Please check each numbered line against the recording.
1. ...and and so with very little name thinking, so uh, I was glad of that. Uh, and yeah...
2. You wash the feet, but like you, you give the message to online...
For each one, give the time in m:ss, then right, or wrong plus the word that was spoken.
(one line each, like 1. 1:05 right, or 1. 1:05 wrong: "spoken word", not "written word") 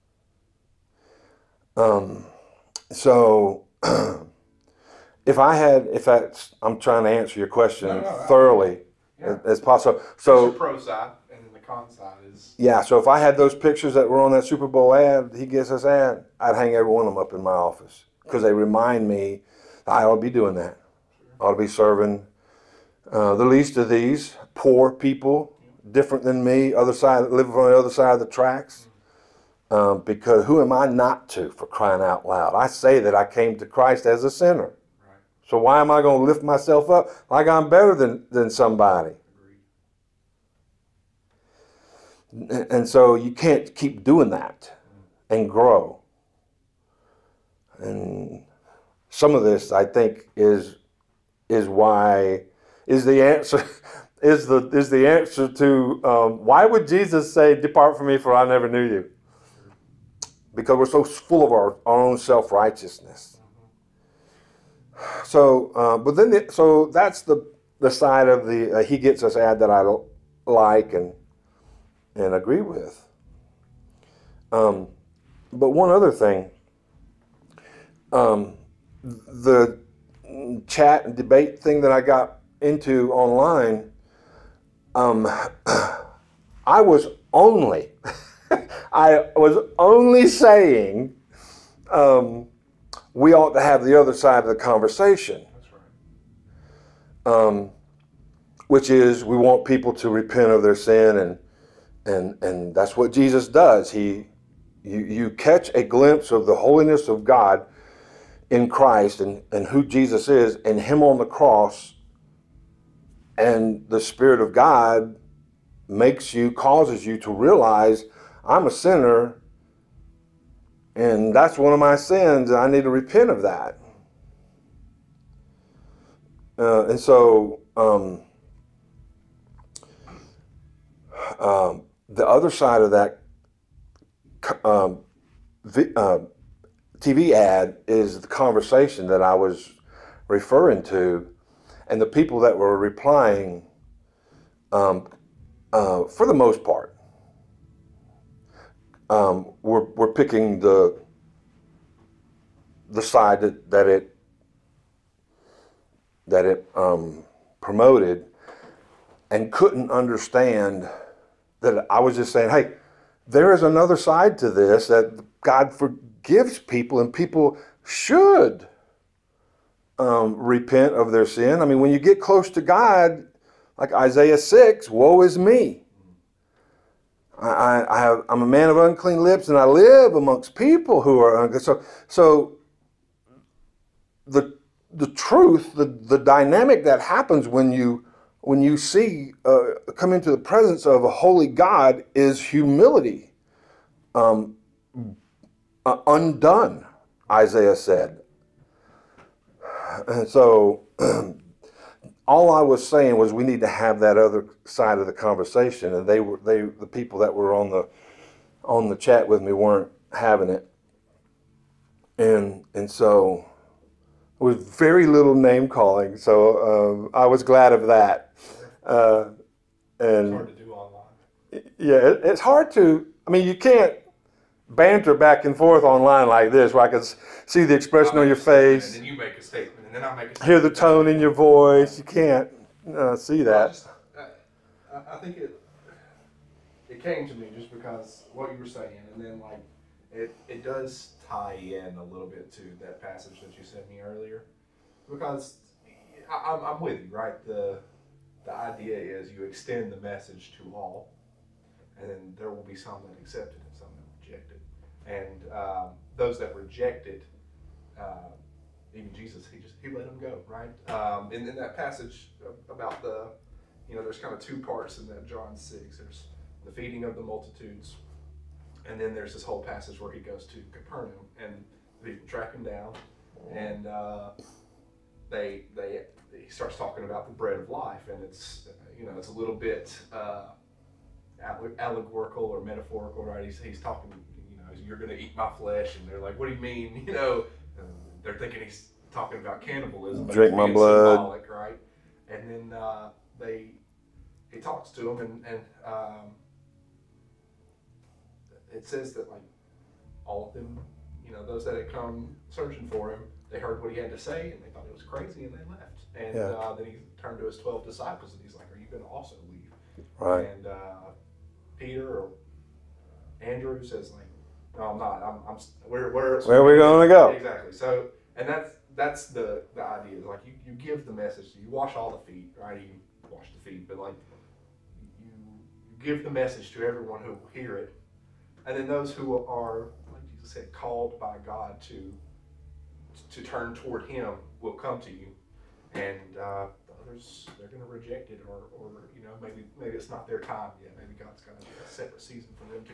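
1. 3:32 wrong: "calling", not "thinking"
2. 5:22 wrong: "everyone", not "online".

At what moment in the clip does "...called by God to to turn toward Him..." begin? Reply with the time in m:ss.
5:30.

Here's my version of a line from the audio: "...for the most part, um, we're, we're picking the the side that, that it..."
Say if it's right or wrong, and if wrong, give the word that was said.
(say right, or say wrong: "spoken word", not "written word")
right.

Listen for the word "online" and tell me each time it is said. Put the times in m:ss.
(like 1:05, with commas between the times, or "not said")
1:23, 3:45.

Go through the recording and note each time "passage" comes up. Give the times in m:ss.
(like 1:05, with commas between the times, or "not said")
4:03, 4:21, 4:29.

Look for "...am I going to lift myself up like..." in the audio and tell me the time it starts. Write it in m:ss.
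0:35.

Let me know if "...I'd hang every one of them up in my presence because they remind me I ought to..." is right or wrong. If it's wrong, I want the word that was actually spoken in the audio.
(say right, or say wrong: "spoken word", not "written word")
wrong: "office", not "presence".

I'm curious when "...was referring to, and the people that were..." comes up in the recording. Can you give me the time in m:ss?
2:19.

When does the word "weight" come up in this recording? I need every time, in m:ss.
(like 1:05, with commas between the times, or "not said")
not said.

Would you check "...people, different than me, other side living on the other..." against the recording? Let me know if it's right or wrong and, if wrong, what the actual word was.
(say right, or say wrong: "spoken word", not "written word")
right.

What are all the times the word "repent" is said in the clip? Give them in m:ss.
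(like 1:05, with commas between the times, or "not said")
1:40, 2:02, 2:50.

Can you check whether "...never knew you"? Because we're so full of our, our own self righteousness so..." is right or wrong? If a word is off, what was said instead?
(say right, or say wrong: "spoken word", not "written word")
right.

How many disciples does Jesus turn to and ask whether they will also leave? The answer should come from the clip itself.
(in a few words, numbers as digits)
12.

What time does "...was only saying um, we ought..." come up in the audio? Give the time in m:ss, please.
1:29.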